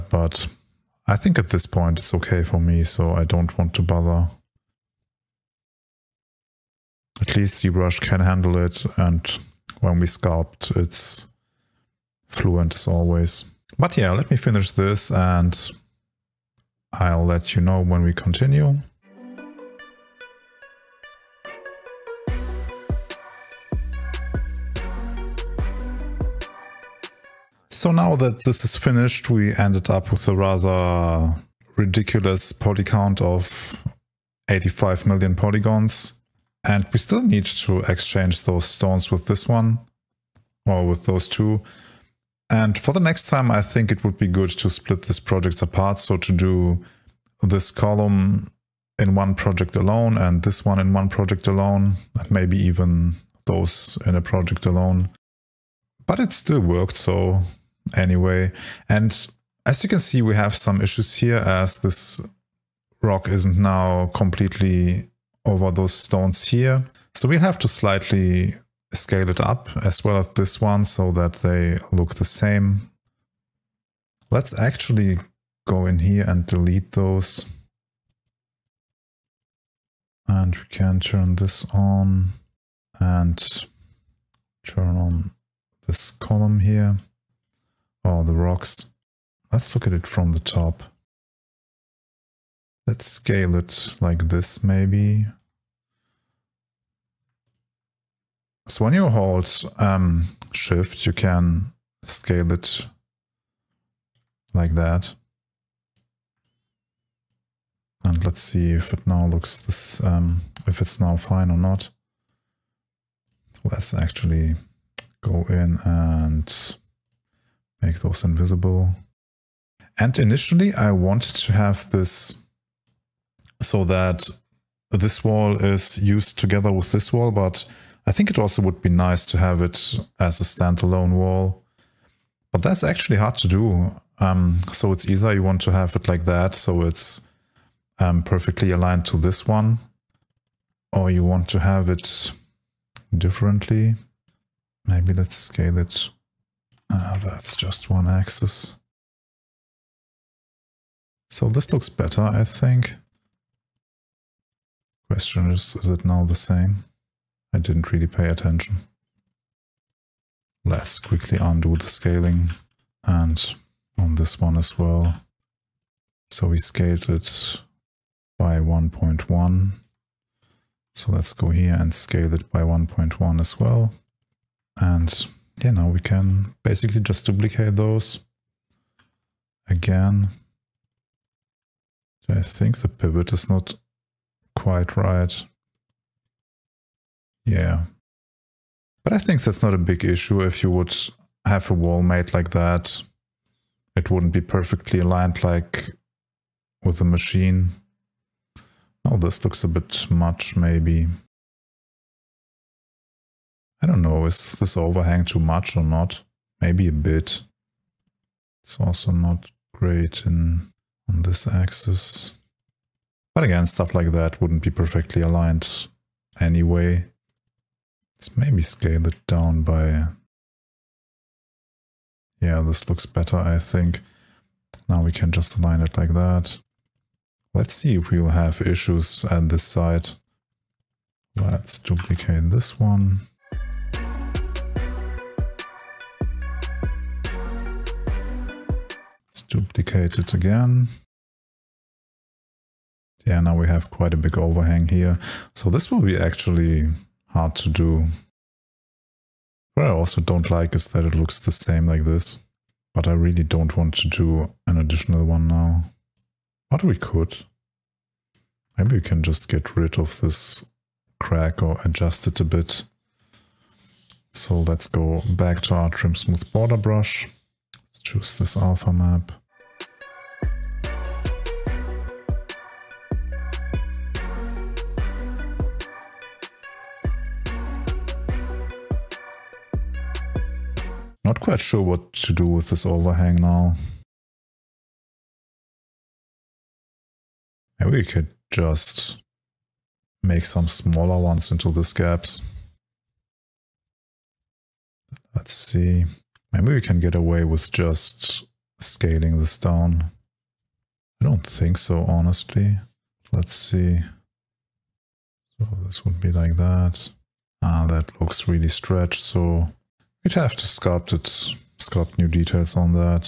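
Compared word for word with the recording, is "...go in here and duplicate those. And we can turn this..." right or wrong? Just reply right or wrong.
wrong.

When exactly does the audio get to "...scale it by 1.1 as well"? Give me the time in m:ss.
2:51.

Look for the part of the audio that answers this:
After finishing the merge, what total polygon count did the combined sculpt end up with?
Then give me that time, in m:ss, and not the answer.
0:34.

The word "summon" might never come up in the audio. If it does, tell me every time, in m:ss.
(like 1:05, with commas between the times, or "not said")
not said.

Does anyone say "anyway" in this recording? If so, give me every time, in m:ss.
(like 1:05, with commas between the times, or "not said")
0:57, 3:36.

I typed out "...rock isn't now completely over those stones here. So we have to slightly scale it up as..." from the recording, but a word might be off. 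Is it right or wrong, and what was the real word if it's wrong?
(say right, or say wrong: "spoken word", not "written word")
right.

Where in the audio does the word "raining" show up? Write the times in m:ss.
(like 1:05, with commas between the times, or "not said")
not said.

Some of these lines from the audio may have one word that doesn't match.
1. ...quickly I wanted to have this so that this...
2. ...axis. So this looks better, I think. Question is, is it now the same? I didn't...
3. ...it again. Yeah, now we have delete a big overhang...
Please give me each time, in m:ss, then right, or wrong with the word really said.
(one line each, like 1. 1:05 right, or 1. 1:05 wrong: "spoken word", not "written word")
1. 2:00 wrong: "initially", not "quickly"
2. 2:28 right
3. 4:00 wrong: "quite", not "delete".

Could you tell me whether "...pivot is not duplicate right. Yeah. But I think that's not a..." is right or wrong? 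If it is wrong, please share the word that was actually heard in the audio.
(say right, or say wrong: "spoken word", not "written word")
wrong: "quite", not "duplicate".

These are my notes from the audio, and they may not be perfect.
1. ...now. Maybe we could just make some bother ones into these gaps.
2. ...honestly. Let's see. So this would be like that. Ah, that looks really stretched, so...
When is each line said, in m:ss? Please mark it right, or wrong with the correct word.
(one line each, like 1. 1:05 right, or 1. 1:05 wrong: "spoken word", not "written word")
1. 4:43 wrong: "smaller", not "bother"
2. 5:02 right.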